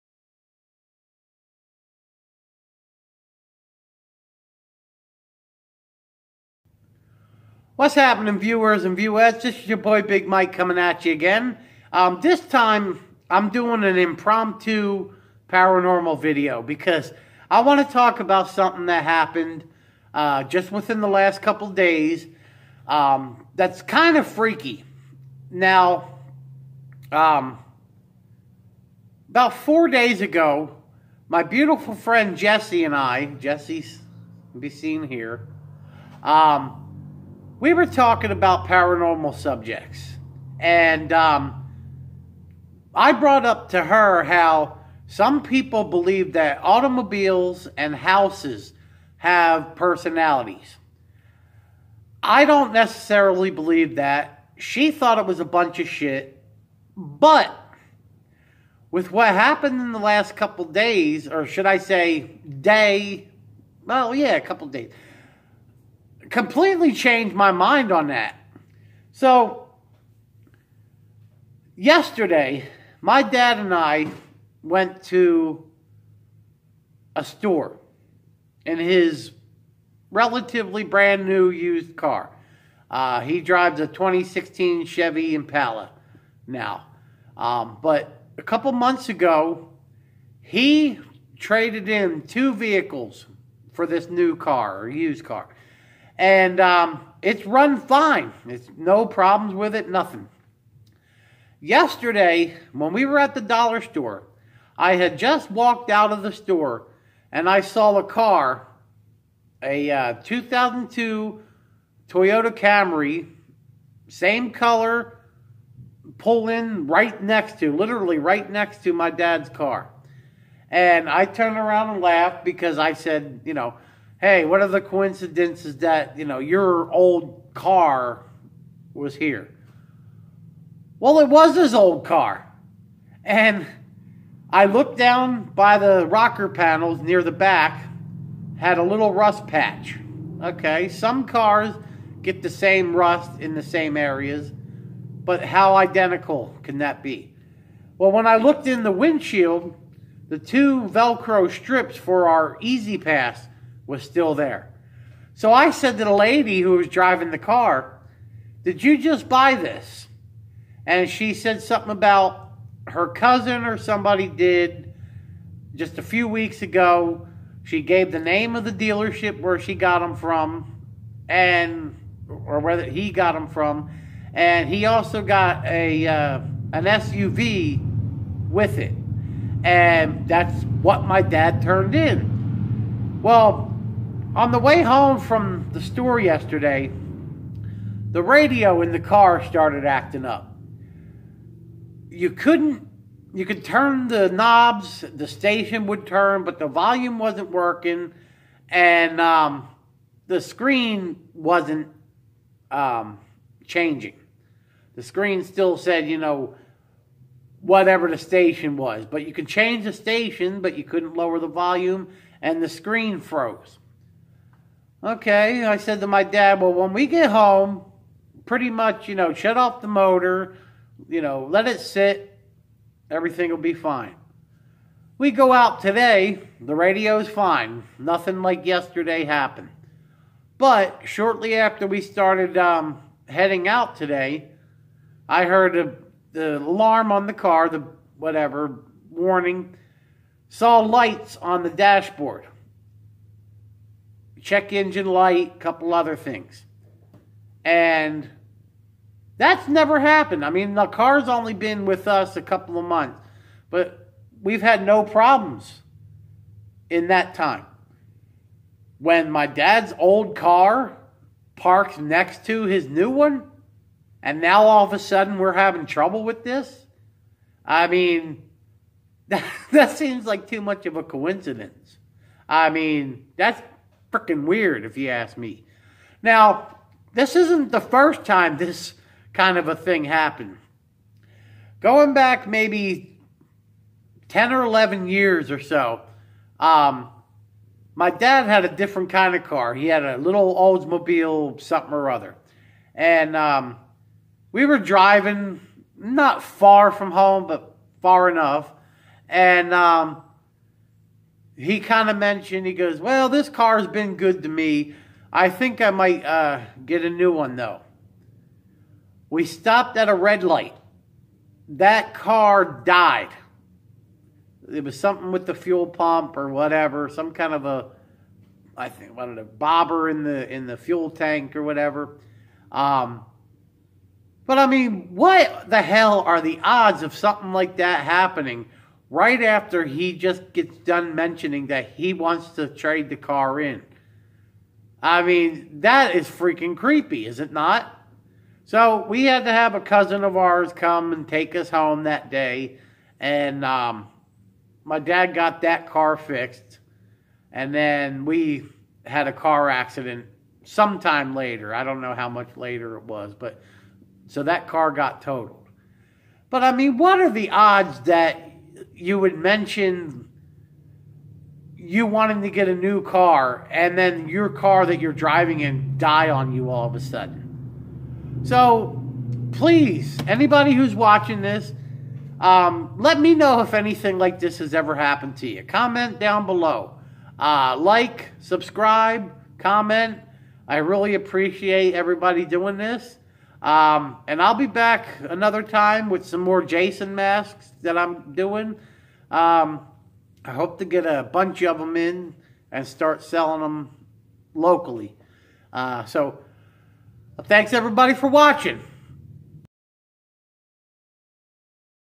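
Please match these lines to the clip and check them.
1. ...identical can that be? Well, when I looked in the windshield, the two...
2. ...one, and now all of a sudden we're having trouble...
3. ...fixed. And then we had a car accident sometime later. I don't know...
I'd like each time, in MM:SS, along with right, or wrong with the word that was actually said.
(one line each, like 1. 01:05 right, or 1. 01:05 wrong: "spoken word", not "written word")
1. 02:25 right
2. 04:23 right
3. 05:46 right.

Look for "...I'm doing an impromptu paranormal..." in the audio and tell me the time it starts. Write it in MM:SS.
00:13.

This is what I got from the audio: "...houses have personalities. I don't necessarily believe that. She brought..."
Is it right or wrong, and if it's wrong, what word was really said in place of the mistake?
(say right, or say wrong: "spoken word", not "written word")
wrong: "thought", not "brought".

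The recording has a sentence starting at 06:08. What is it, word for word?
So please, anybody who's watching this, um, let me know if anything like this has ever happened to you.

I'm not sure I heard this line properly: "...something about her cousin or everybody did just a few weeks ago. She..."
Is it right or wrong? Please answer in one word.
wrong.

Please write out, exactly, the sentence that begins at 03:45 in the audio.
We go out today, the radio's fine.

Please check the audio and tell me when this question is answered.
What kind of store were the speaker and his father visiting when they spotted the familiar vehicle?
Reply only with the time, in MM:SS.
01:43.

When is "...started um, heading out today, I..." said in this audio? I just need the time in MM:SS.
03:52.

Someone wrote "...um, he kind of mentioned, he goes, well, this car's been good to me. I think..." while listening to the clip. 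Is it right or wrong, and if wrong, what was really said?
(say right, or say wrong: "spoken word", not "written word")
right.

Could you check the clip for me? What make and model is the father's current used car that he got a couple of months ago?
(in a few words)
2016 Chevy Impala.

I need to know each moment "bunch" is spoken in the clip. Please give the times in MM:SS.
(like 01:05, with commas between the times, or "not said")
00:55, 06:31.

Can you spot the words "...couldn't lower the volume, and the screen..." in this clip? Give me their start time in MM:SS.
03:30.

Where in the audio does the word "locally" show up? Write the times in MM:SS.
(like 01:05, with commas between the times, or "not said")
06:34.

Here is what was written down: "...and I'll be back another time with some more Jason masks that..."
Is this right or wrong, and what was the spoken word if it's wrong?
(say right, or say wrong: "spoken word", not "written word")
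right.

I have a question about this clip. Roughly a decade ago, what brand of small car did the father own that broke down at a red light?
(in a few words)
Oldsmobile.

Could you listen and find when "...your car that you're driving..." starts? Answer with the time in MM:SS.
06:04.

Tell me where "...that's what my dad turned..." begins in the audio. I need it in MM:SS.
03:00.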